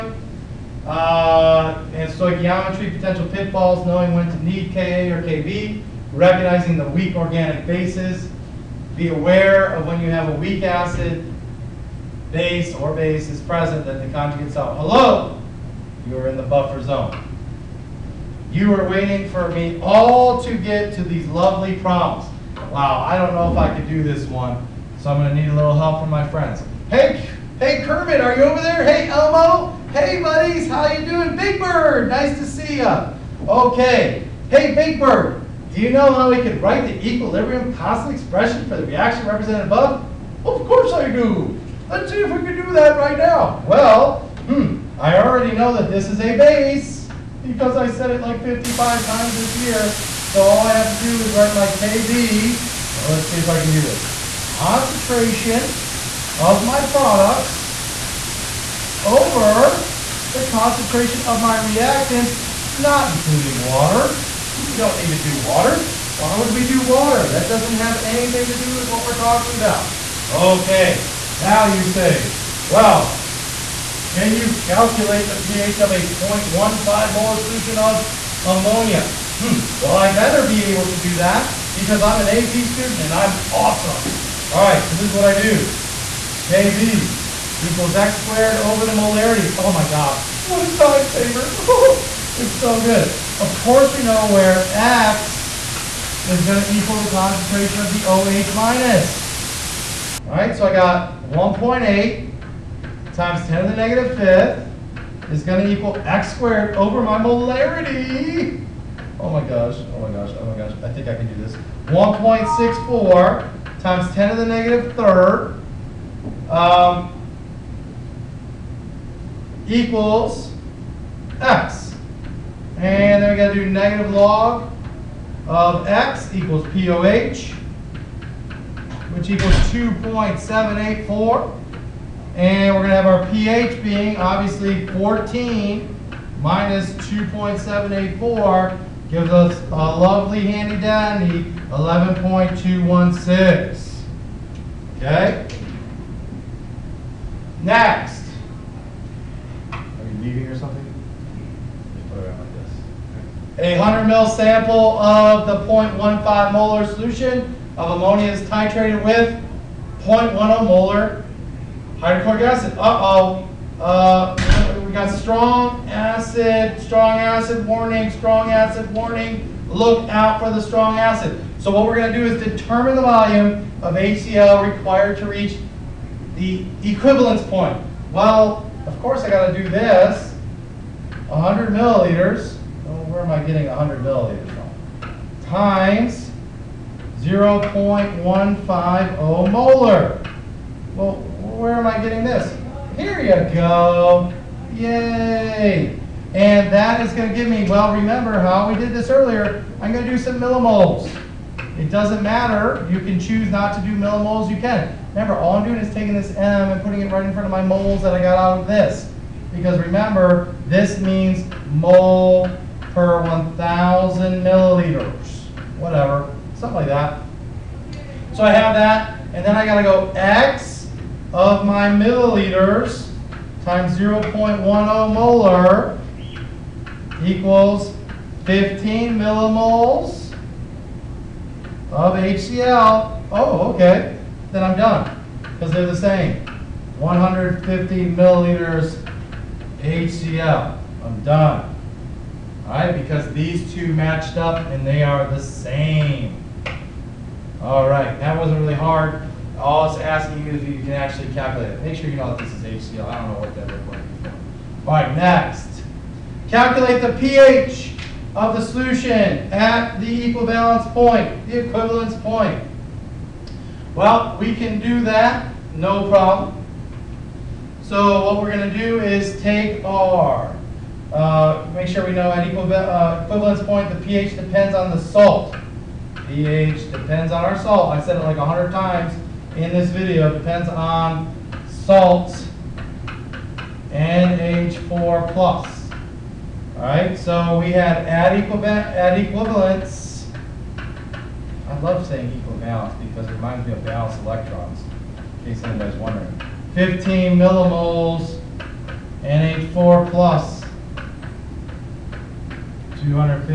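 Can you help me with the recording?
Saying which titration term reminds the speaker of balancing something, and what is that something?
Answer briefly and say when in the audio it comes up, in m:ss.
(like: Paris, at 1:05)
electrons, at 4:53.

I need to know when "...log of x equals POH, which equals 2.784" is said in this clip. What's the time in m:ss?
2:04.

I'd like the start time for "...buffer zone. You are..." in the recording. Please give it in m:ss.
0:16.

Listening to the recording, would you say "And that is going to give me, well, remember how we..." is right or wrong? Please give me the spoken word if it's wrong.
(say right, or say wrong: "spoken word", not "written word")
right.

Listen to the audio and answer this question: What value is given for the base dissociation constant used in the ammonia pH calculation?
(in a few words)
1.8 x 10^-5.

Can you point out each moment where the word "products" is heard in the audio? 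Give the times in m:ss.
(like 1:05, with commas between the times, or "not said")
0:56.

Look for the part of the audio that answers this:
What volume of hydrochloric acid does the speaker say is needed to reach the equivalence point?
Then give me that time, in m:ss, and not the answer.
3:56.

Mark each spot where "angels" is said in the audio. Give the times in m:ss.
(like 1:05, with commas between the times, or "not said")
not said.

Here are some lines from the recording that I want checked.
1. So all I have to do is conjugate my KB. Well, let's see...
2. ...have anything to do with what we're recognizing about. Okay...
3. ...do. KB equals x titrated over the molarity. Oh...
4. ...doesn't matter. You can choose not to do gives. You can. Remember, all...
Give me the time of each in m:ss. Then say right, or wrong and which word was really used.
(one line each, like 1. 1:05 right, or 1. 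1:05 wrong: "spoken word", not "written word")
1. 0:50 wrong: "write", not "conjugate"
2. 1:07 wrong: "talking", not "recognizing"
3. 1:25 wrong: "squared", not "titrated"
4. 3:21 wrong: "millimoles", not "gives".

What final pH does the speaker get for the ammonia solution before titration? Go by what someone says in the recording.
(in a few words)
11.216.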